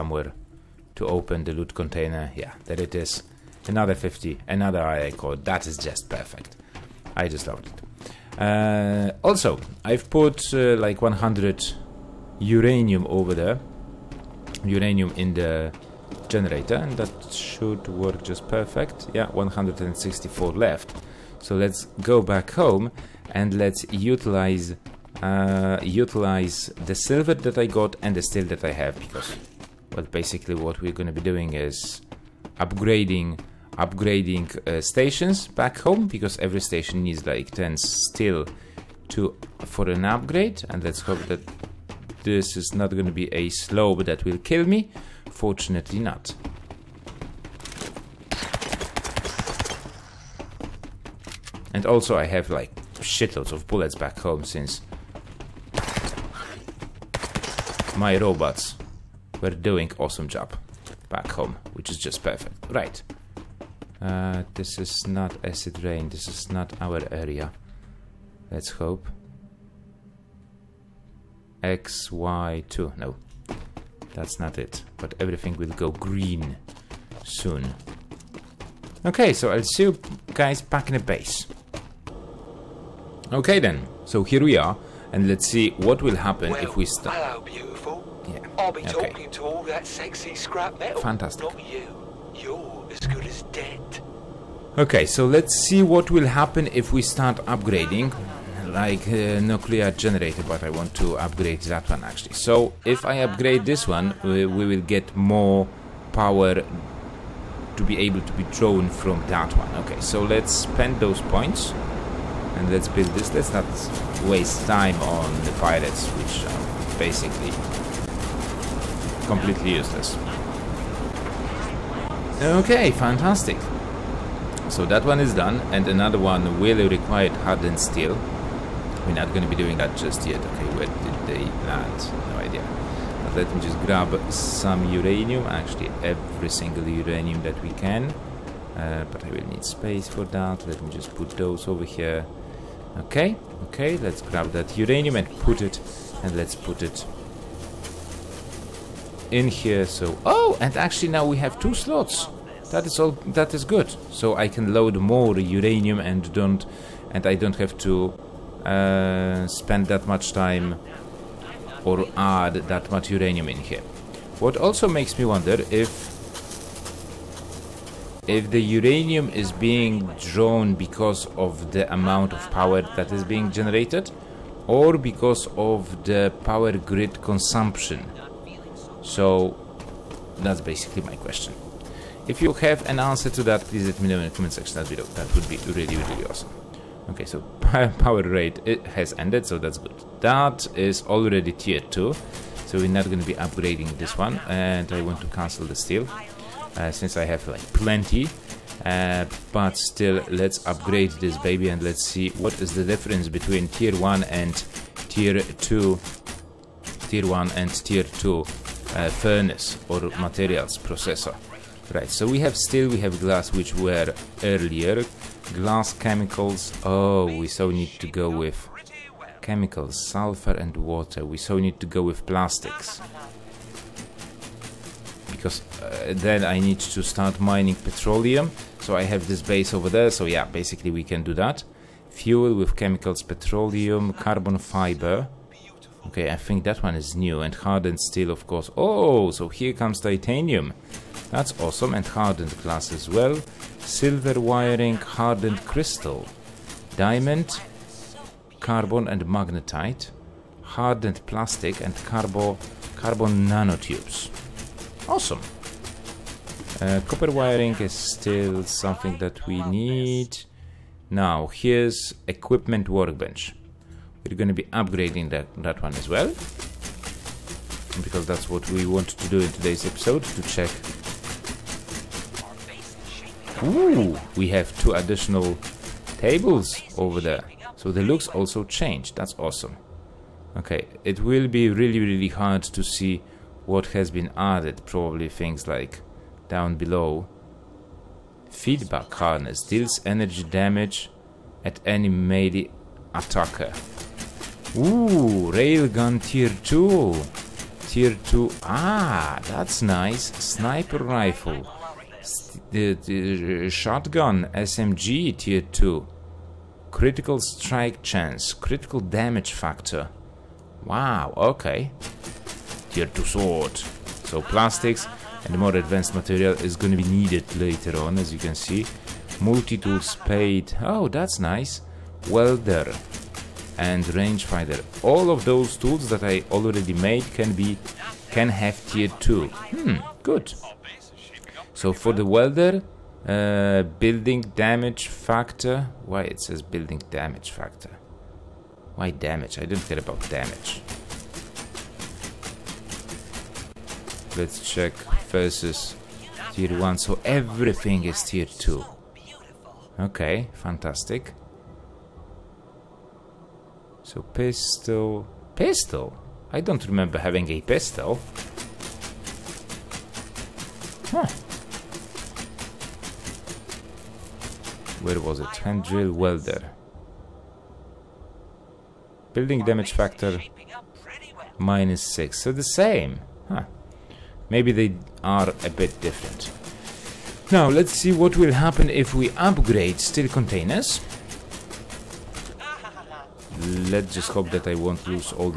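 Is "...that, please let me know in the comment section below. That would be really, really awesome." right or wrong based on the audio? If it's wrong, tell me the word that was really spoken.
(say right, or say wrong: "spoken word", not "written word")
right.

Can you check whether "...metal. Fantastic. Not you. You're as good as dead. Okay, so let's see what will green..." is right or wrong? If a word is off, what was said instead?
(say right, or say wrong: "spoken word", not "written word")
wrong: "happen", not "green".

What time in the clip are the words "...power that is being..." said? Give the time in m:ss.
2:52.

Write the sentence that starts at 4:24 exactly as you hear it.
We're going to be upgrading that, that one as well.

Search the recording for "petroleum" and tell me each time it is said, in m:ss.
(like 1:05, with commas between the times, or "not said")
3:47, 3:53.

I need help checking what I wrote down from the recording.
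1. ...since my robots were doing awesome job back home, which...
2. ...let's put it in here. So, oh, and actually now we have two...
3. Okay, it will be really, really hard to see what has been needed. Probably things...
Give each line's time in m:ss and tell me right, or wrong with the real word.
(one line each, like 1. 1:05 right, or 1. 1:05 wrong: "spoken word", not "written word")
1. 0:54 right
2. 2:26 right
3. 4:40 wrong: "added", not "needed".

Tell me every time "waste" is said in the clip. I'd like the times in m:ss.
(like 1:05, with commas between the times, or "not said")
1:54.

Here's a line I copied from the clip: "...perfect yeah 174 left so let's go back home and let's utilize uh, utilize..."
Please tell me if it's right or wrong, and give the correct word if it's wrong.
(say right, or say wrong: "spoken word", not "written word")
wrong: "164", not "174".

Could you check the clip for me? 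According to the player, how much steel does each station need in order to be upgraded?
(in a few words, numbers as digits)
10.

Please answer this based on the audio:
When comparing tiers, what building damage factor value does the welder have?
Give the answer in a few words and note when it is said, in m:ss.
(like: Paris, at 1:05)
-6, at 6:11.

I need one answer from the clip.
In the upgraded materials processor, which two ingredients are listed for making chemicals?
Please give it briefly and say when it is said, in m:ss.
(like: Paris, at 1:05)
sulfur and water, at 3:40.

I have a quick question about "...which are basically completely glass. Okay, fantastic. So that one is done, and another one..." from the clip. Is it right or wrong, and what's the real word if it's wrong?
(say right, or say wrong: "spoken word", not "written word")
wrong: "useless", not "glass".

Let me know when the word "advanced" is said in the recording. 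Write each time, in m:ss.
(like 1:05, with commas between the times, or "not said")
5:15.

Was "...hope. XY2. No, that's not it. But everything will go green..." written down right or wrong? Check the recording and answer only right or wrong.
right.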